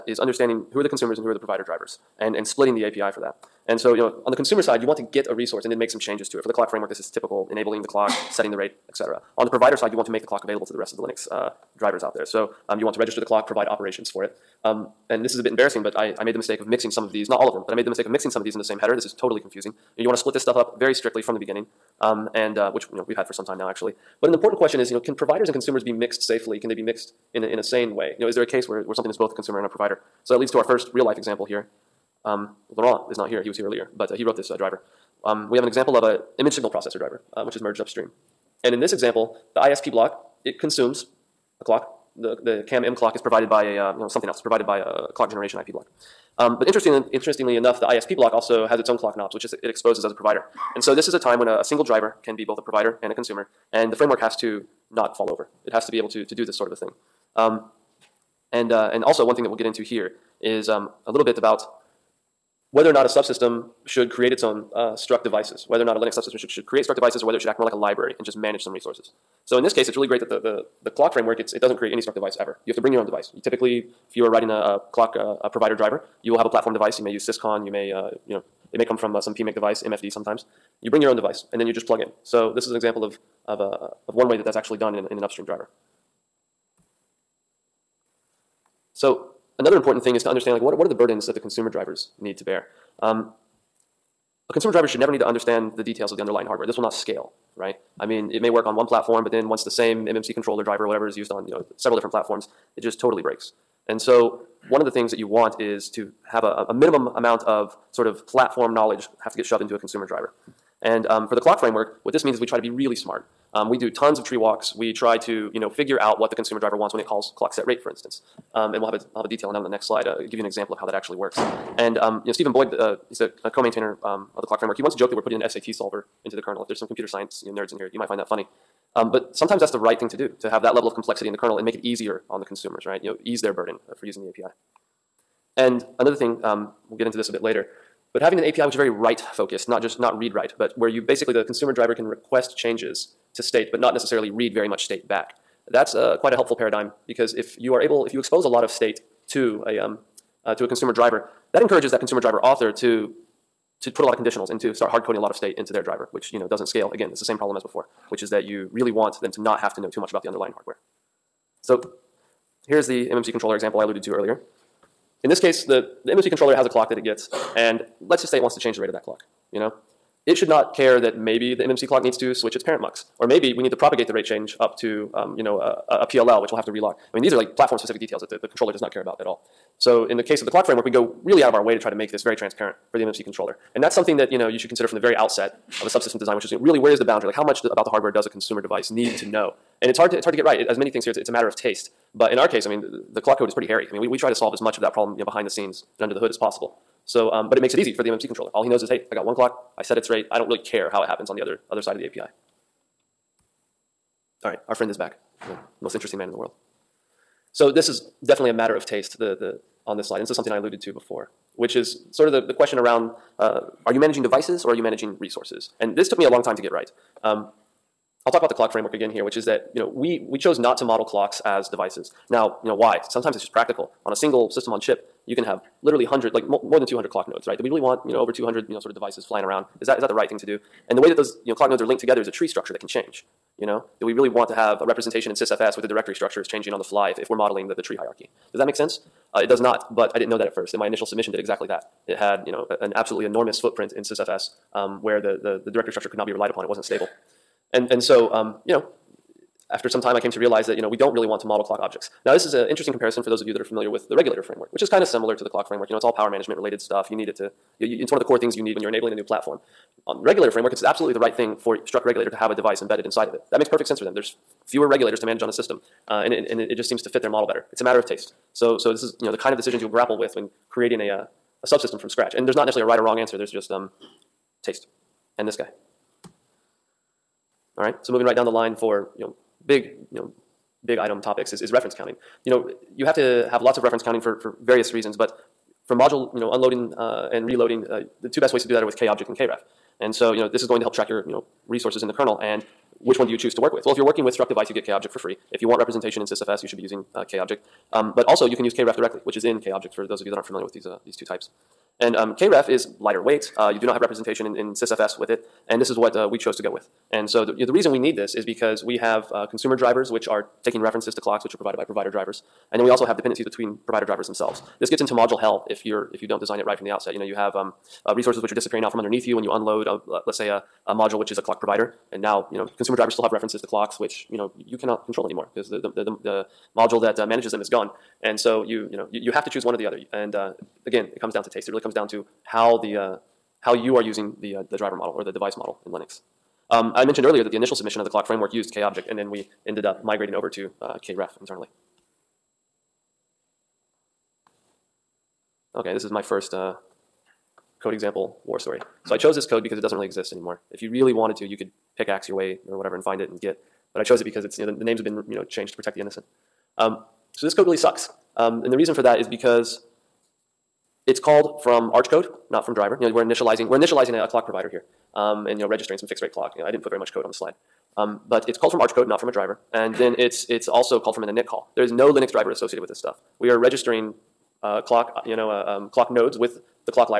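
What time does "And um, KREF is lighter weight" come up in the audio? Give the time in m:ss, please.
5:02.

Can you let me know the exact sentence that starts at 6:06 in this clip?
You know, I didn't put very much code on the slide, um, but it's called from Arch code, not from a driver.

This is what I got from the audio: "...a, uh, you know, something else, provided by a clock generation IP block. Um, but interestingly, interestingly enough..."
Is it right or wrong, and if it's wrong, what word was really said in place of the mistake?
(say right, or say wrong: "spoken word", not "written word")
right.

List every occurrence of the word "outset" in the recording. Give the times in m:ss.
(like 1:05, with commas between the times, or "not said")
3:05, 5:16.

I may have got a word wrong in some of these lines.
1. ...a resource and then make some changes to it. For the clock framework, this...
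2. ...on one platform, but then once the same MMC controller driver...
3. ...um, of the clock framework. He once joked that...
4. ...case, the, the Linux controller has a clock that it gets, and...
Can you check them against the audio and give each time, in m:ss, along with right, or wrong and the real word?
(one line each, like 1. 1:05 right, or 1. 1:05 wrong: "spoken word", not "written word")
1. 0:05 right
2. 1:38 right
3. 2:04 right
4. 2:45 wrong: "MMC", not "Linux".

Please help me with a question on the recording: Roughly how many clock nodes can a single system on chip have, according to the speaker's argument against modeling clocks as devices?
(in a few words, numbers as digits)
more than 200.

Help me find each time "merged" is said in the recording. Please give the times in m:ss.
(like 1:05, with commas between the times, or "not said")
0:37.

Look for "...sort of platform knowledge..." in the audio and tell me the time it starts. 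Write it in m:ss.
1:47.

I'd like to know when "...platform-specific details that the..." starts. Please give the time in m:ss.
2:57.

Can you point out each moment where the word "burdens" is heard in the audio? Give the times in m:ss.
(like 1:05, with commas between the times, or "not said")
1:30, 2:13.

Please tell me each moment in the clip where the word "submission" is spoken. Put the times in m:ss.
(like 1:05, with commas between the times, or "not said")
4:01, 5:37.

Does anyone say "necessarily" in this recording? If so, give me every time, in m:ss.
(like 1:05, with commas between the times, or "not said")
2:23, 4:32.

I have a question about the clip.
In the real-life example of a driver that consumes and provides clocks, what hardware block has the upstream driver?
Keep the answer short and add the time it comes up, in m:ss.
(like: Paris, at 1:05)
image signal processor, at 0:36.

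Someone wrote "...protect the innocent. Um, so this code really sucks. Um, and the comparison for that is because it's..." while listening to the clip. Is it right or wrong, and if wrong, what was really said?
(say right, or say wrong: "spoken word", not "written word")
wrong: "reason", not "comparison".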